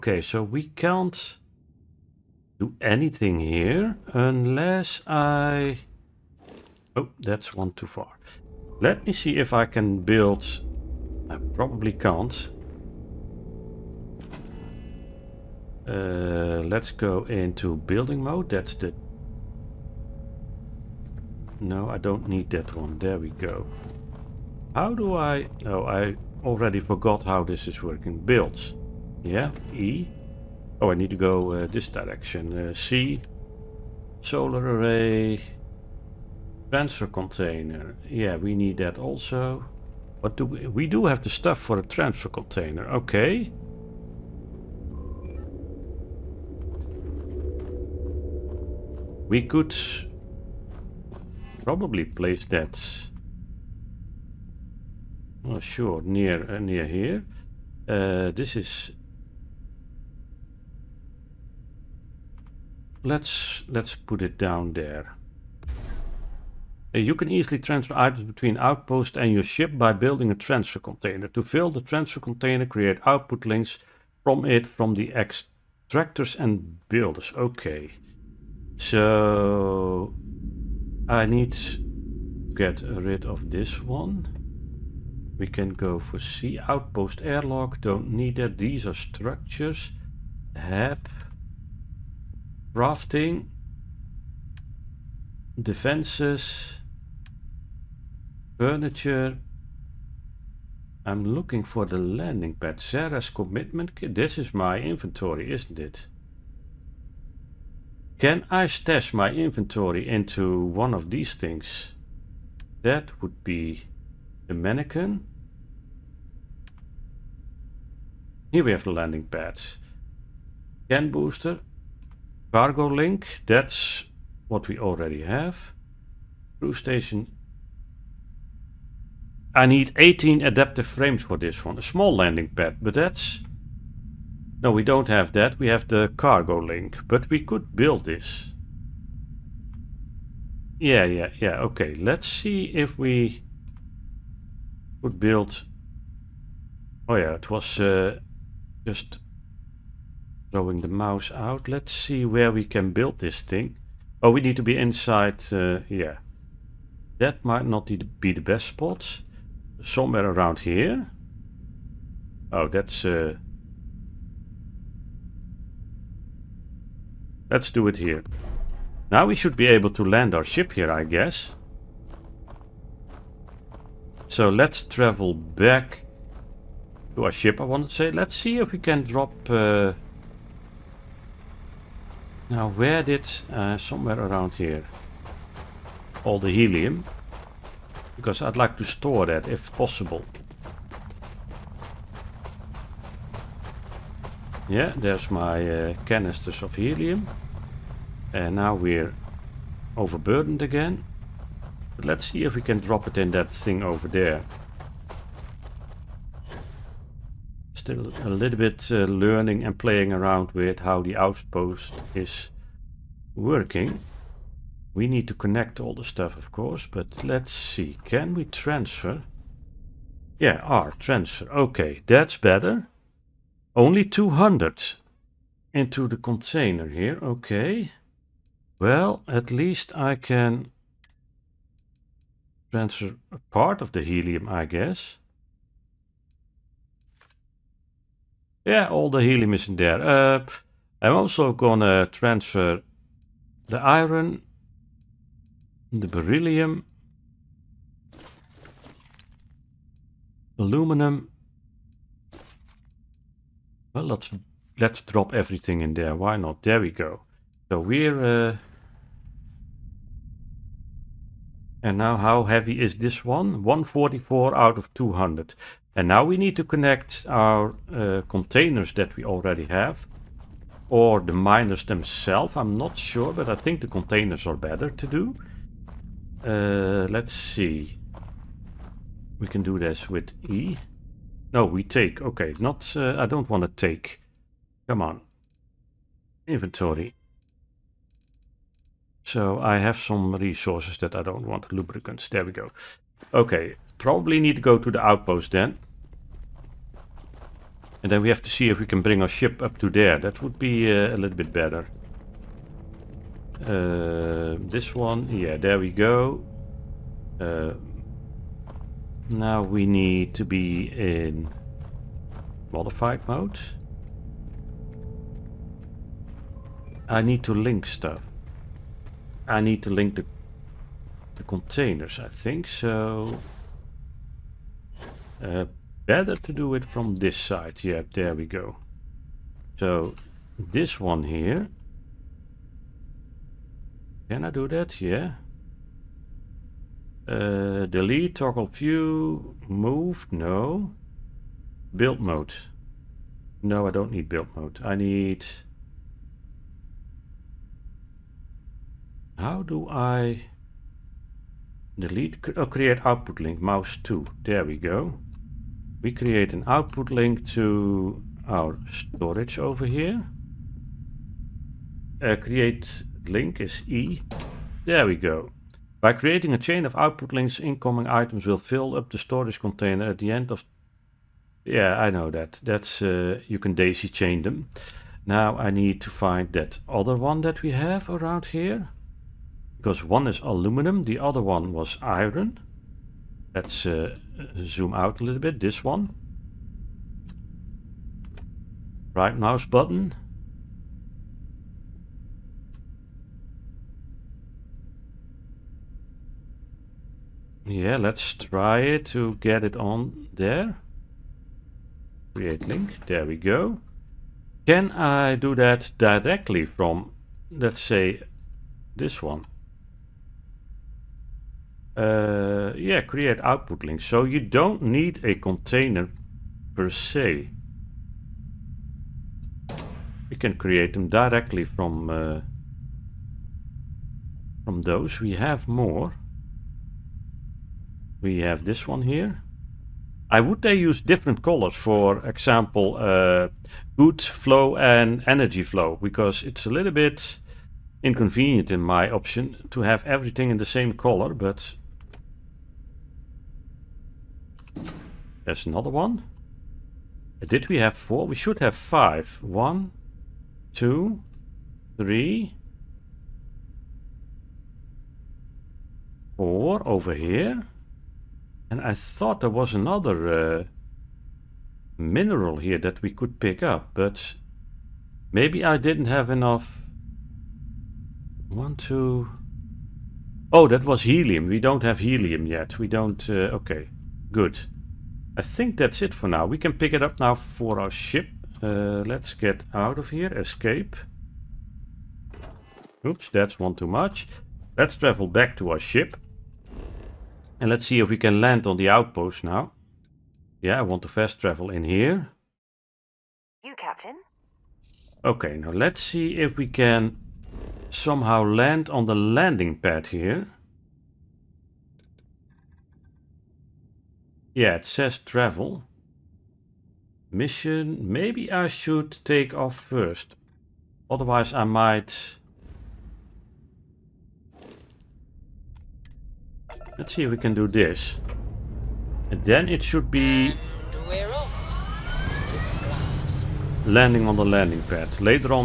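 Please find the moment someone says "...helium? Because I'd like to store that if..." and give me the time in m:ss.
3:06.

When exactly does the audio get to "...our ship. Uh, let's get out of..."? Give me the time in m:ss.
7:57.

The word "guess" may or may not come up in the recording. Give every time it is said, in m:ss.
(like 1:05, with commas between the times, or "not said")
2:51, 3:54.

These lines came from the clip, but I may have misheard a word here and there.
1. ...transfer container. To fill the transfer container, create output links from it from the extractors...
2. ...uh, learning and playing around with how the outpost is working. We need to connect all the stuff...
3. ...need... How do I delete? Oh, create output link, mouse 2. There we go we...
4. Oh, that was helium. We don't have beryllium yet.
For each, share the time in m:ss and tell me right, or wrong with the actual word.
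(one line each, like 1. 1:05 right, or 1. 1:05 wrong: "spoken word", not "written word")
1. 1:10 right
2. 3:28 right
3. 5:44 right
4. 7:50 wrong: "helium", not "beryllium".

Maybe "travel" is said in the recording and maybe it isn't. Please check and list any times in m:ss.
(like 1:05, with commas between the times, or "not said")
2:54, 8:04, 8:11, 8:25.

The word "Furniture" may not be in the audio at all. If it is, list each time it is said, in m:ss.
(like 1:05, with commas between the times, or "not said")
1:38.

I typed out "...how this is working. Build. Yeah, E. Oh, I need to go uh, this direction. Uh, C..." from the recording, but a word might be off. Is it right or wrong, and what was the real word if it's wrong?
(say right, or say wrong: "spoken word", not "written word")
right.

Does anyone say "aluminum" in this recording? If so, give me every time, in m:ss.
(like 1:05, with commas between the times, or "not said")
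4:10, 6:20.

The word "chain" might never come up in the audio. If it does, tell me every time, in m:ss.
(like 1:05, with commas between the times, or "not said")
6:06, 6:14.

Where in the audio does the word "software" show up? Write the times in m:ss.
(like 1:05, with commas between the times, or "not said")
not said.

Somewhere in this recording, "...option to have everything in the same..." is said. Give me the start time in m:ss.
7:19.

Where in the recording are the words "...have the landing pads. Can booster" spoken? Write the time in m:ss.
1:58.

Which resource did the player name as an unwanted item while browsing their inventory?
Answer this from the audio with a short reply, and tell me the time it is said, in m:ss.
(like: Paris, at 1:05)
Lubricants, at 4:51.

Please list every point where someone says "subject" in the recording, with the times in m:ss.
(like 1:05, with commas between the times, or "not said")
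not said.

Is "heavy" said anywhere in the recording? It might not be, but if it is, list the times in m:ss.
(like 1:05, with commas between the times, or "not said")
4:22.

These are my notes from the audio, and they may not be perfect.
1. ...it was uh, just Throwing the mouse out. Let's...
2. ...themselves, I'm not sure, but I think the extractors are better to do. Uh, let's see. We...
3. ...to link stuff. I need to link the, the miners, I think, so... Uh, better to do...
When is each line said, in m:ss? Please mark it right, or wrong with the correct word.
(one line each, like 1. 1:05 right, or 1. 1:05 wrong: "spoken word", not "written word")
1. 2:27 right
2. 4:31 wrong: "containers", not "extractors"
3. 5:17 wrong: "containers", not "miners".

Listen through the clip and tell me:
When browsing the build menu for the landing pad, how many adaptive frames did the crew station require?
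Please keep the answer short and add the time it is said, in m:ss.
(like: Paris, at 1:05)
18, at 2:09.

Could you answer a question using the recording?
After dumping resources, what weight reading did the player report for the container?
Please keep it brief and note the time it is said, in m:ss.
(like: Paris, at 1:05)
144, at 4:23.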